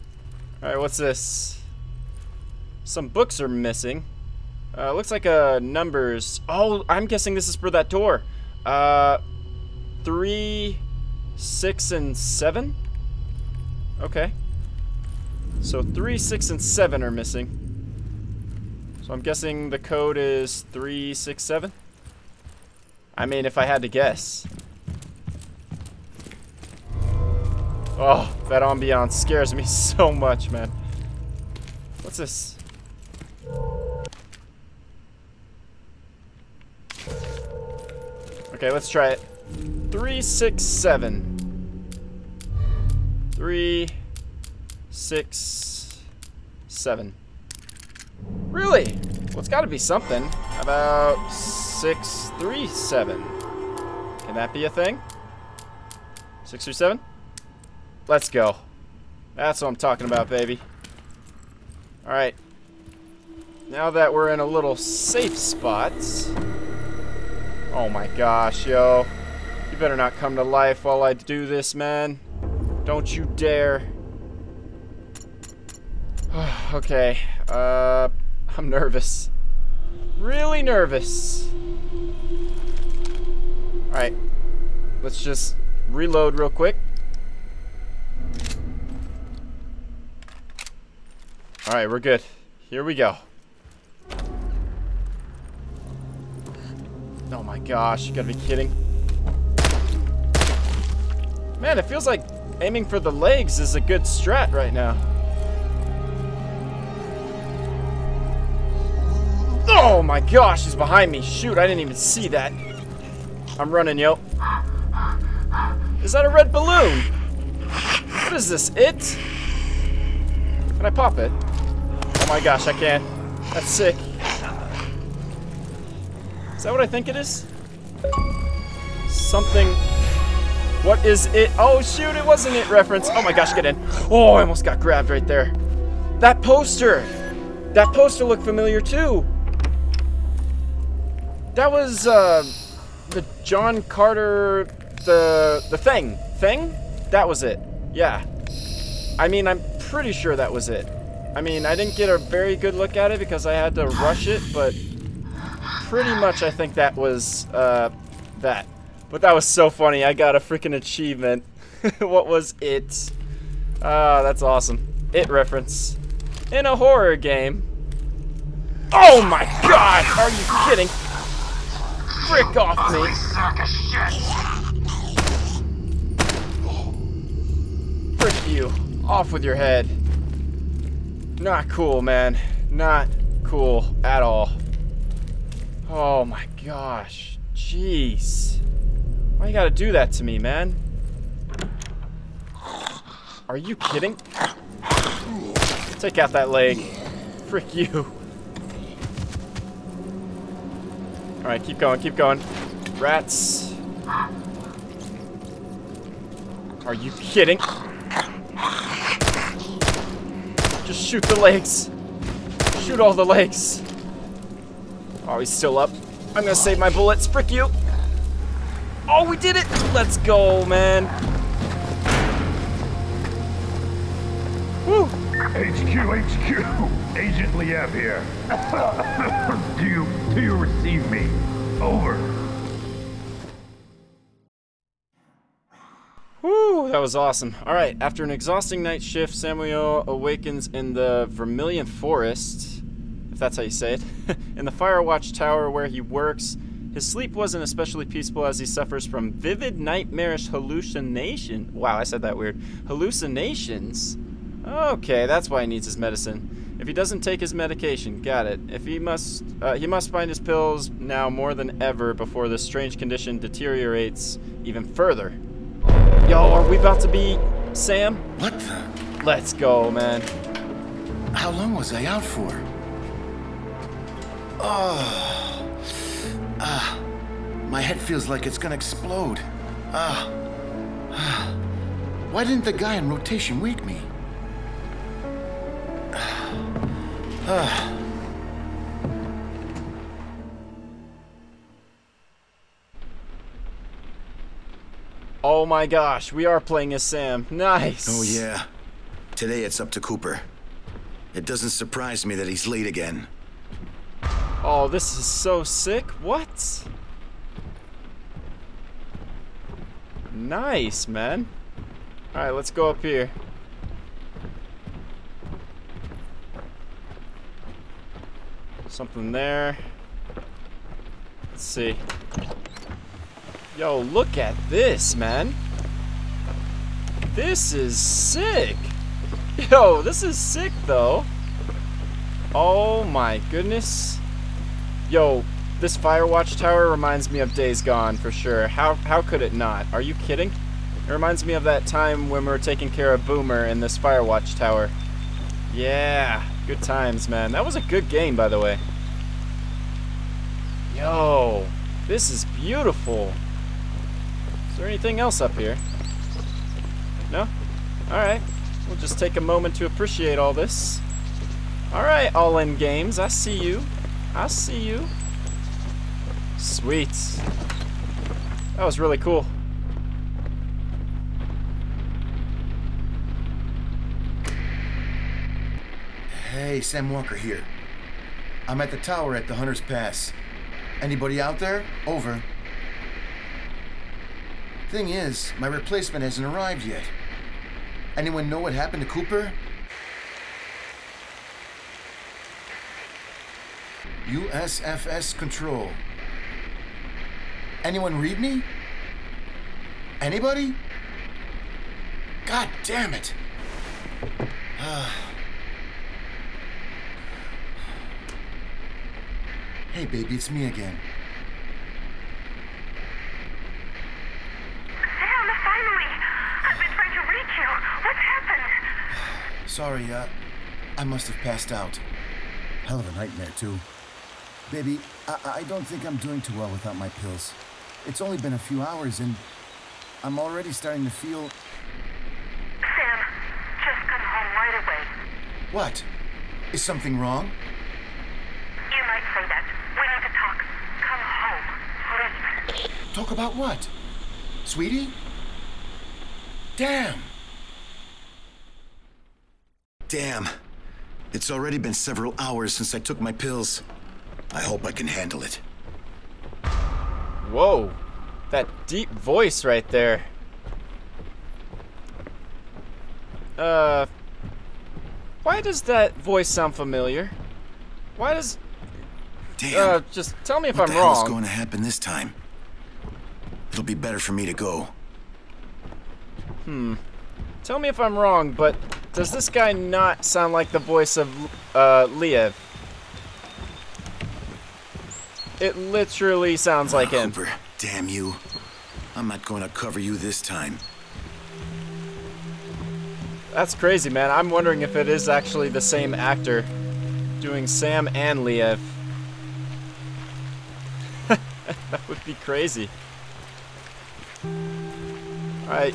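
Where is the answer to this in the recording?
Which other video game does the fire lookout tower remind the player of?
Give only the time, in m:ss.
5:37.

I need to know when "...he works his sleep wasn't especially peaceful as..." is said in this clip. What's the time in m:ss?
4:05.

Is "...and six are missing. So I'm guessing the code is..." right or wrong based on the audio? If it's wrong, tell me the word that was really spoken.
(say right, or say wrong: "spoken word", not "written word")
wrong: "seven", not "six".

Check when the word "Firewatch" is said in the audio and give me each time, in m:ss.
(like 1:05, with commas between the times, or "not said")
4:04, 5:35, 5:43.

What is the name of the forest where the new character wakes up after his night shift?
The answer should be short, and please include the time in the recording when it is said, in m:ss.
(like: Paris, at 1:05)
Vermilion Forest, at 4:01.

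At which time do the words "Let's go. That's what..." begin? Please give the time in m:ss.
0:58.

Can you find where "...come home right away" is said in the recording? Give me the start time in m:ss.
7:14.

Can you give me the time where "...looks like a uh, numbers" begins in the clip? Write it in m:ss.
0:04.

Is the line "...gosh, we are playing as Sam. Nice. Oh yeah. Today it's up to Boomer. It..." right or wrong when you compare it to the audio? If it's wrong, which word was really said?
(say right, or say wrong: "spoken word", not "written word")
wrong: "Cooper", not "Boomer".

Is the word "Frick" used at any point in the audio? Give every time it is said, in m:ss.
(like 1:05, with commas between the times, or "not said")
2:52, 2:58, 3:17, 3:37.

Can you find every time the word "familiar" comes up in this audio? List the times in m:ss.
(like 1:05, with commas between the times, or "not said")
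2:18, 7:46.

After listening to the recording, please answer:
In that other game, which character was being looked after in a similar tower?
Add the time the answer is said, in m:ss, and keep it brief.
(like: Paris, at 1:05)
Boomer, at 5:43.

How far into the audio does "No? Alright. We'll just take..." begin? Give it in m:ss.
5:57.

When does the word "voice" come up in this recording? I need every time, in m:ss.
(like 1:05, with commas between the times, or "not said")
7:39, 7:46, 8:00.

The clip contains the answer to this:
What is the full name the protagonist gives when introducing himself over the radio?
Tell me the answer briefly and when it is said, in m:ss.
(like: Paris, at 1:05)
Sam Walker, at 6:16.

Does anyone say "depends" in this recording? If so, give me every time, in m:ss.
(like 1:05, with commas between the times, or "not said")
not said.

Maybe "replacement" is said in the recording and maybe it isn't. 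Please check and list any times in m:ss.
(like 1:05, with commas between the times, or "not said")
6:25.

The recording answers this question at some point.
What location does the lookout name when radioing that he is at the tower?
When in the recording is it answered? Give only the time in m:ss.
6:19.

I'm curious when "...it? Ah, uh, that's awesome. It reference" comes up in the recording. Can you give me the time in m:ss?
2:42.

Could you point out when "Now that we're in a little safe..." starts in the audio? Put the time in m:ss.
1:03.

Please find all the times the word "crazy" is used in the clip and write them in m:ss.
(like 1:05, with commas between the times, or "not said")
8:13, 8:22.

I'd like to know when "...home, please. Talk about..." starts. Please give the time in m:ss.
7:23.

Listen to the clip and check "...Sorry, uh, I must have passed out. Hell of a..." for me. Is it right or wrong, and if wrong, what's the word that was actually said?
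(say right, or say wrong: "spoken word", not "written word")
right.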